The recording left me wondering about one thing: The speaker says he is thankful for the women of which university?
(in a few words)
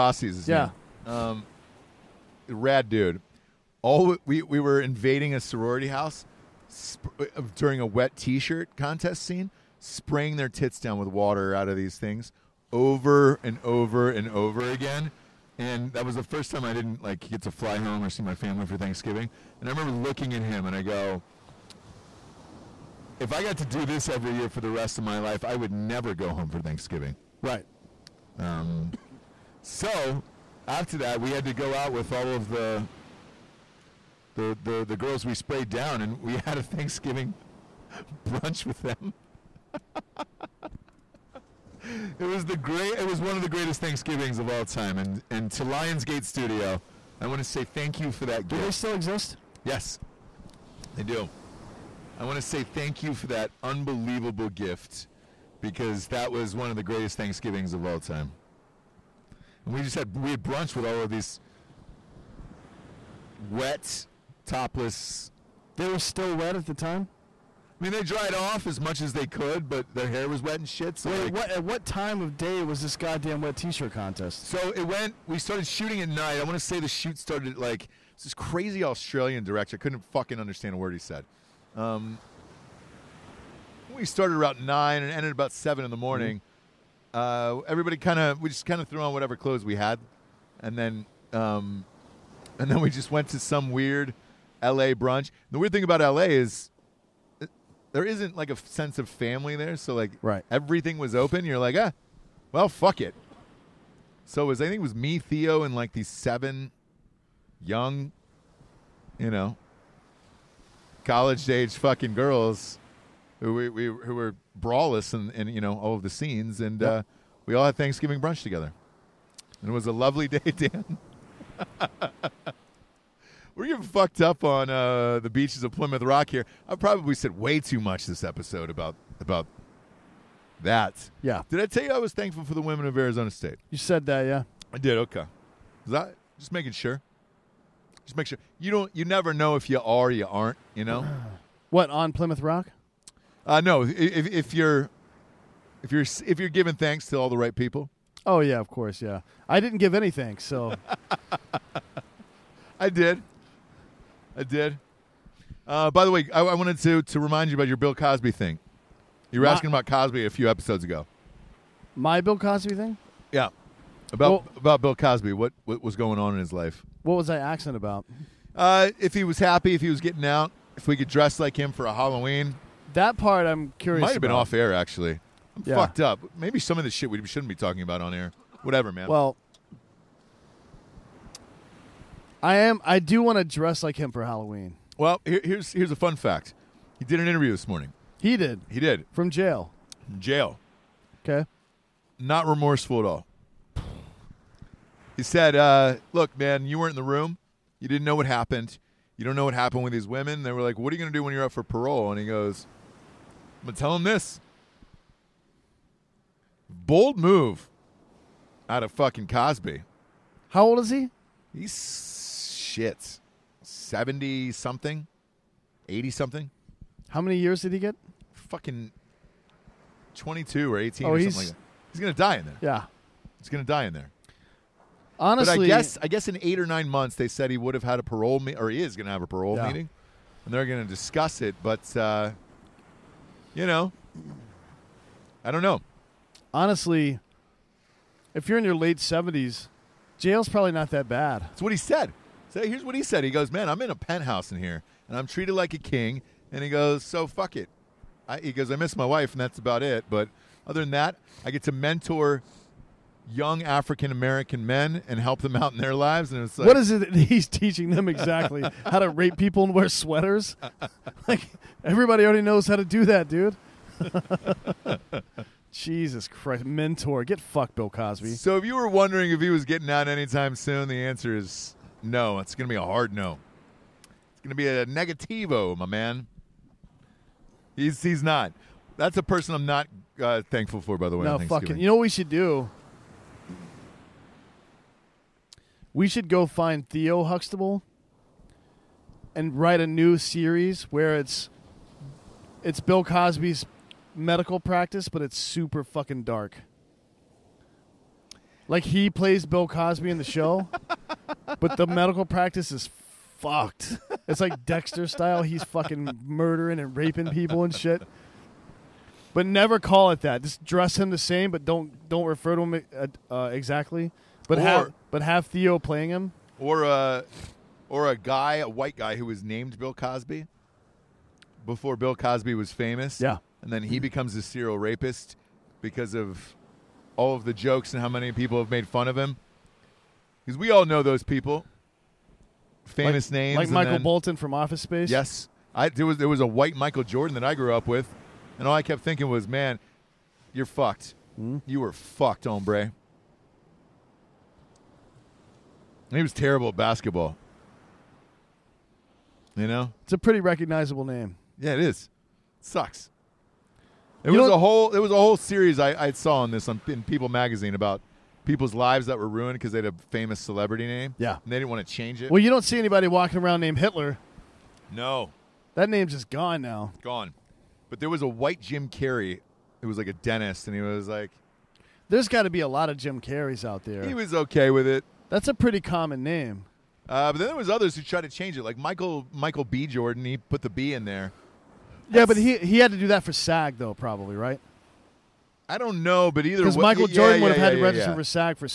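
Arizona State.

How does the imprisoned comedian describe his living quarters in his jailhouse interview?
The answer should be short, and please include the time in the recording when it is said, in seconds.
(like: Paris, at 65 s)
a penthouse, at 243 s.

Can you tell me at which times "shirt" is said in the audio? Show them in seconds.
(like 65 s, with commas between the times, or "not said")
8 s, 73 s.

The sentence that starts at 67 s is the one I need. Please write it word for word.
I mean, they dried off as much as they could, but their hair was wet and shit.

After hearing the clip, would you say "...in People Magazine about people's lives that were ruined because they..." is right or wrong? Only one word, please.
right.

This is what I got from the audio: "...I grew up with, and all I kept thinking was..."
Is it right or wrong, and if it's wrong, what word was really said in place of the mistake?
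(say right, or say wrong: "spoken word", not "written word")
right.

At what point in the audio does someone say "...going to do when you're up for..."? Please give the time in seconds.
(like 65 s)
200 s.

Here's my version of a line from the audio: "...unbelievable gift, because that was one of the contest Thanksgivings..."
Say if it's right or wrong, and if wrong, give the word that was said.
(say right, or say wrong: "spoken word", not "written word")
wrong: "greatest", not "contest".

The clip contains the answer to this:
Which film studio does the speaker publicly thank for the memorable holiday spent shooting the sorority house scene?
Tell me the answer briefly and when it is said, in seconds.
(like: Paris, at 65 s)
Lionsgate, at 45 s.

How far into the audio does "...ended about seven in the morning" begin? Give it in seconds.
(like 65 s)
85 s.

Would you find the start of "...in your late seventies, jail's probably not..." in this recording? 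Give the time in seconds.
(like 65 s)
238 s.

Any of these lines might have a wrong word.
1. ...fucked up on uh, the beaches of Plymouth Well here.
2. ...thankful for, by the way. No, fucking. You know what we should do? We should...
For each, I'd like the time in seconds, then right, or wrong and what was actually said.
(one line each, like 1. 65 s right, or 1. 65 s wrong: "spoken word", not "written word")
1. 123 s wrong: "Rock", not "Well"
2. 280 s right.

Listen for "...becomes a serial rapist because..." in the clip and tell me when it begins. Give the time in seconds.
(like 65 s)
323 s.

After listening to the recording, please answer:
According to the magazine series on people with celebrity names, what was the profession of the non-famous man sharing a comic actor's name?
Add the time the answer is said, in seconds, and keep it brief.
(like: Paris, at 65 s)
dentist, at 370 s.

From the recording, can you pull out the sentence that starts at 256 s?
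And it's like, what is it that he's teaching them exactly?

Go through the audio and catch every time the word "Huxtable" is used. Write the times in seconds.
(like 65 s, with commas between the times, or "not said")
287 s.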